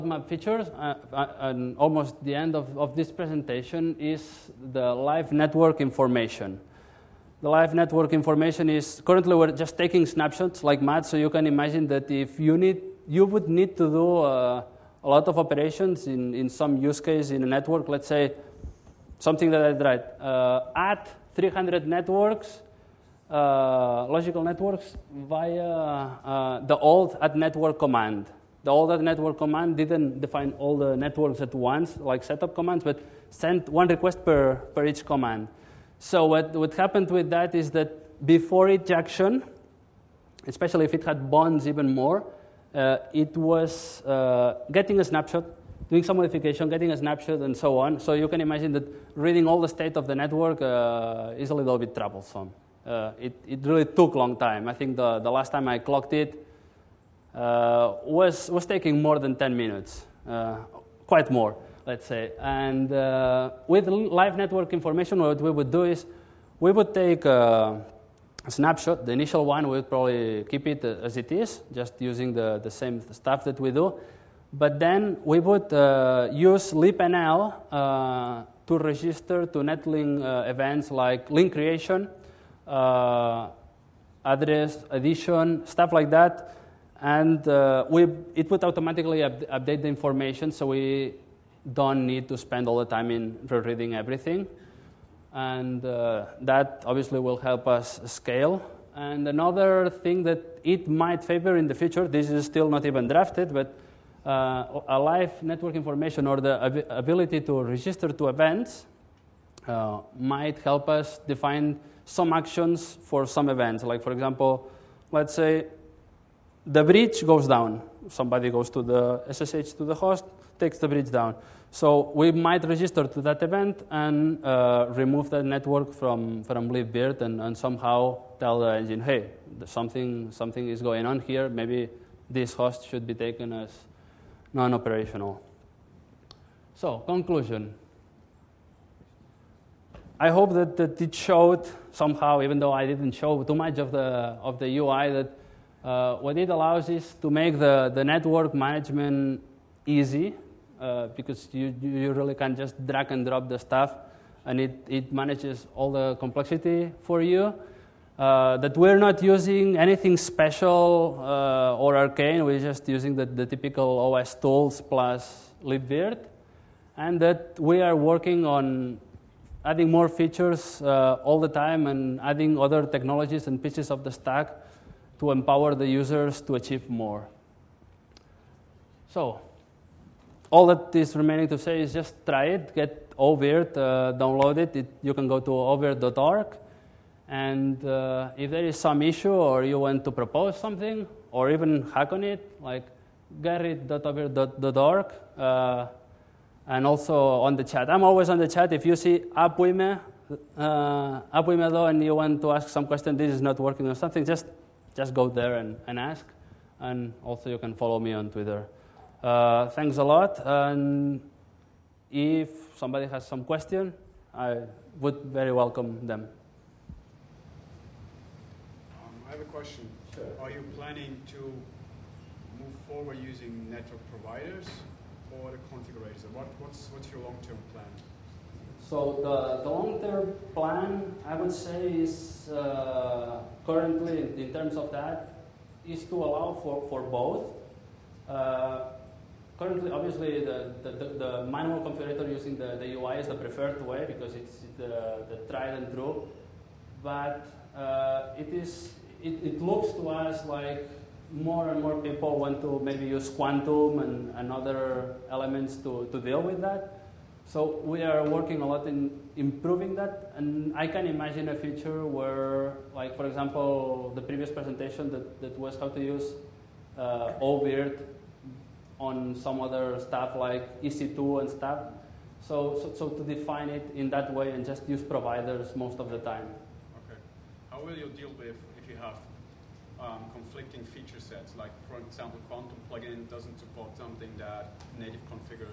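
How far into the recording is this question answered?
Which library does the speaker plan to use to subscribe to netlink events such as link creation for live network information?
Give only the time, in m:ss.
1:16.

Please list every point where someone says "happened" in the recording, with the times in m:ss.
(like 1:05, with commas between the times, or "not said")
0:36.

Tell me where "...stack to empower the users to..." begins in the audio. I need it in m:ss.
2:54.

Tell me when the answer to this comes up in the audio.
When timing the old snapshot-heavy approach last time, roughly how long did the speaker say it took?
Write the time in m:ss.
0:59.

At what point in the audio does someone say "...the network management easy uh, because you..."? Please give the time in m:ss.
2:27.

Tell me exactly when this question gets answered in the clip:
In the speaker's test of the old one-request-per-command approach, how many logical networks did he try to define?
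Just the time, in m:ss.
0:21.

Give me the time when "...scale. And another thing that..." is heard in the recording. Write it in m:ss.
1:38.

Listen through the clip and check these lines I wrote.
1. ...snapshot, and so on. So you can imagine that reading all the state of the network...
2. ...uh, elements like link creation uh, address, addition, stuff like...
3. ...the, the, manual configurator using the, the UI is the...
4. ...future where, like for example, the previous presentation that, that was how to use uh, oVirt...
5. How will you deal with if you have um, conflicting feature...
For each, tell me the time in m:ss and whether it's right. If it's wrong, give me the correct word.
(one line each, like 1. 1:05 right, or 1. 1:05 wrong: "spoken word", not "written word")
1. 0:46 right
2. 1:20 wrong: "events", not "elements"
3. 4:00 right
4. 4:21 right
5. 4:37 right.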